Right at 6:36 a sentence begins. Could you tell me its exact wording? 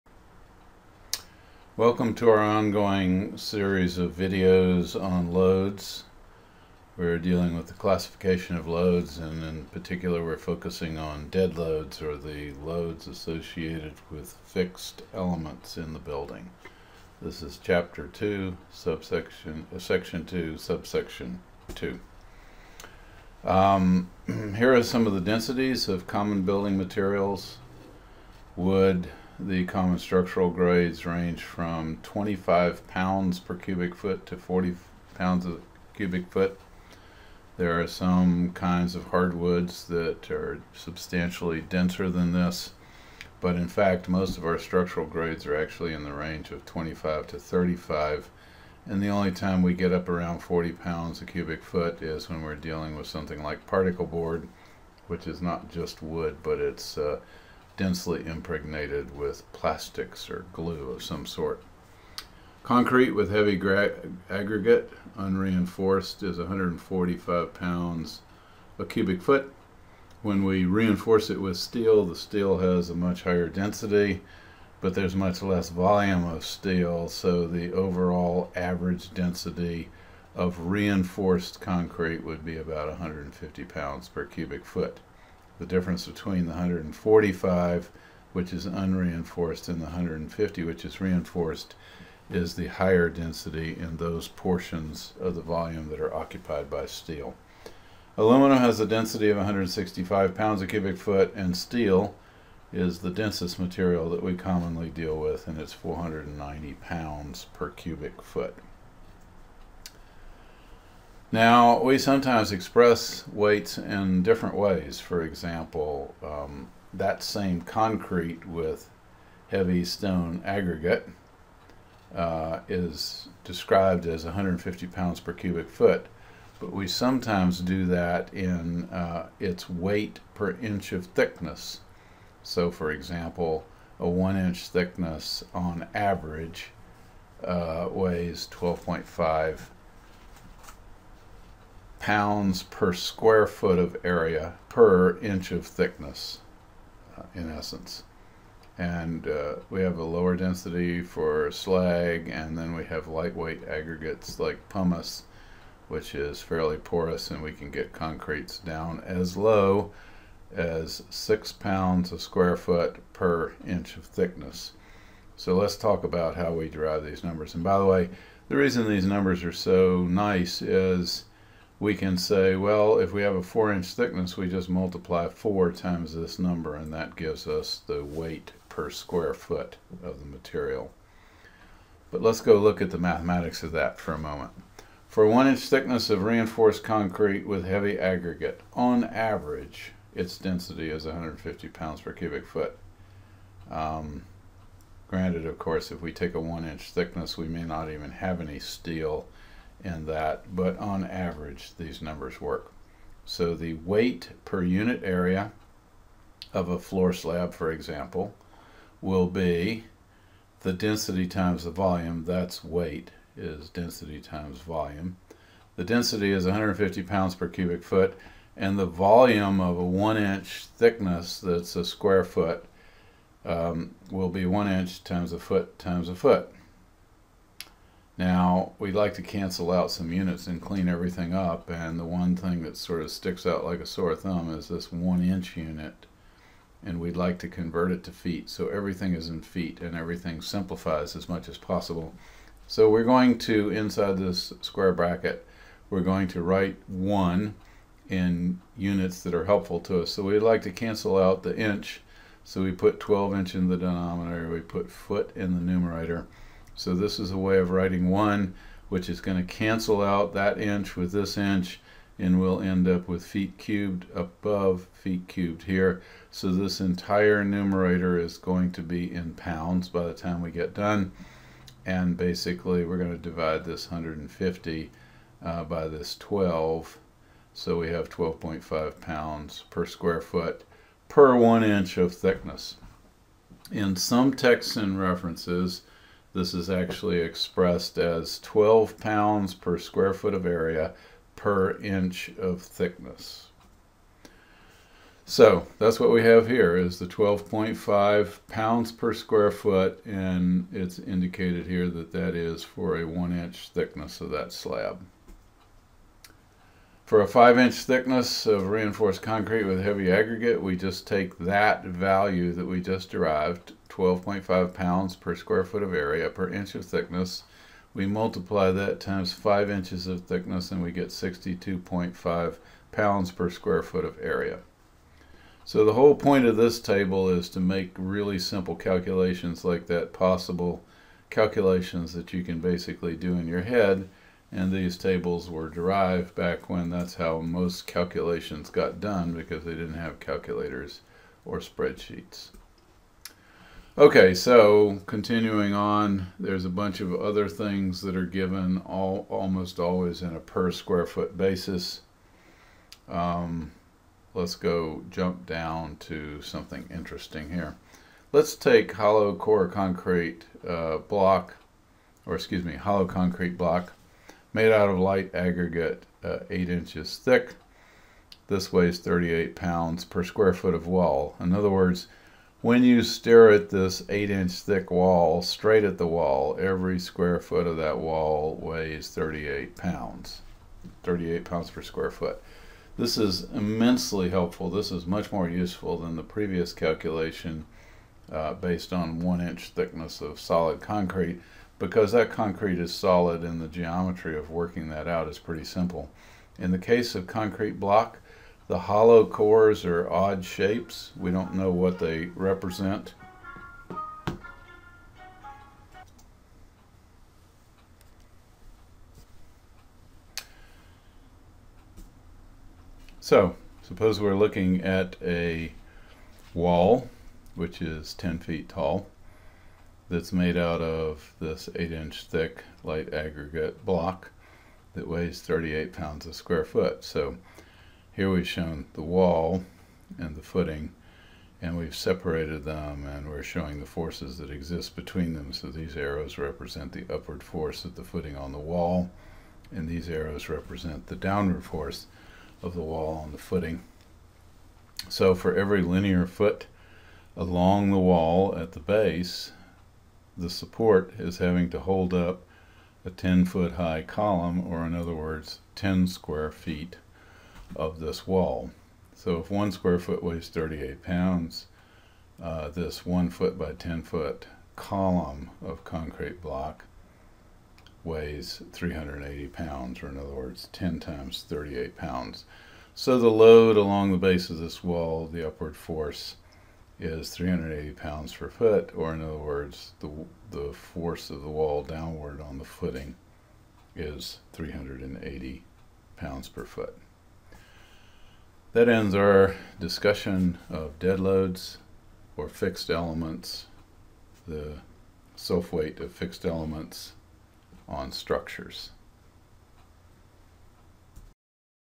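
In the case of concrete block, the hollow cores are odd shapes.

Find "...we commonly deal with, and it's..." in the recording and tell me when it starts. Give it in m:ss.
1:44.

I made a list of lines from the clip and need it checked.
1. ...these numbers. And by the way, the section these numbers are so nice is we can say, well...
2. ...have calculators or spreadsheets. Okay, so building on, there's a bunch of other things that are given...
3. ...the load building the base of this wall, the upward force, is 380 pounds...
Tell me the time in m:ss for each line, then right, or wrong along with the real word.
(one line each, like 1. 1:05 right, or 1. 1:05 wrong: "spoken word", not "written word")
1. 2:47 wrong: "reason", not "section"
2. 5:39 wrong: "continuing", not "building"
3. 7:53 wrong: "along", not "building".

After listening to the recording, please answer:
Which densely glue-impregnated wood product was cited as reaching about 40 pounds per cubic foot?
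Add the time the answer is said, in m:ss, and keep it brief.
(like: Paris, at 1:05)
particle board, at 0:53.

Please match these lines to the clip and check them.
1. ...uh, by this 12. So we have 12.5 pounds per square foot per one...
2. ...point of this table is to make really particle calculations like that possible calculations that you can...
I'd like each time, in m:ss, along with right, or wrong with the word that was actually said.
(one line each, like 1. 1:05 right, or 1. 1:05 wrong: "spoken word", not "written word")
1. 4:35 right
2. 5:26 wrong: "simple", not "particle".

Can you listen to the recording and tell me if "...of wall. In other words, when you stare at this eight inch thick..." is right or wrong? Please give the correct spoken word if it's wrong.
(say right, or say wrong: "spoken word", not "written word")
right.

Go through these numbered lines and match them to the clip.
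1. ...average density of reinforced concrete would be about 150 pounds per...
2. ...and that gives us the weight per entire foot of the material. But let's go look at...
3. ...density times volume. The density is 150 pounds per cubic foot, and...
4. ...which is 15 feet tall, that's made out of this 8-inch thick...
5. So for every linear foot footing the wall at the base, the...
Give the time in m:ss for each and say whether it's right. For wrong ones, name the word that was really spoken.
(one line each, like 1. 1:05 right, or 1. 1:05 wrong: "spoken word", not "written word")
1. 1:18 right
2. 2:56 wrong: "square", not "entire"
3. 3:33 right
4. 6:57 wrong: "10", not "15"
5. 7:25 wrong: "along", not "footing".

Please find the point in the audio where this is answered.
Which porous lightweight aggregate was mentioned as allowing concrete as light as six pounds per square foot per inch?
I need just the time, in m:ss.
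2:34.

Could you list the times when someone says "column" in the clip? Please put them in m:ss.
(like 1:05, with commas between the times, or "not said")
7:34, 7:44.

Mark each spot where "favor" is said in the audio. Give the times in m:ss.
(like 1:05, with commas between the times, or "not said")
not said.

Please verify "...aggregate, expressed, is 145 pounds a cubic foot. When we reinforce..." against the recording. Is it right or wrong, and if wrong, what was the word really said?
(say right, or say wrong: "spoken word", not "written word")
wrong: "unreinforced", not "expressed".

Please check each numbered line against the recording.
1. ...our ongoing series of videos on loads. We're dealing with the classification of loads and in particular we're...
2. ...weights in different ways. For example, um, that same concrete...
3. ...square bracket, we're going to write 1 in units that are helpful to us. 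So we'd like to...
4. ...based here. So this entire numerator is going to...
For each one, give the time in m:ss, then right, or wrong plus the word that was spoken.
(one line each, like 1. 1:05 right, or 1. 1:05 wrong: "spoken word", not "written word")
1. 0:02 right
2. 1:53 right
3. 4:04 right
4. 4:25 wrong: "cubed", not "based".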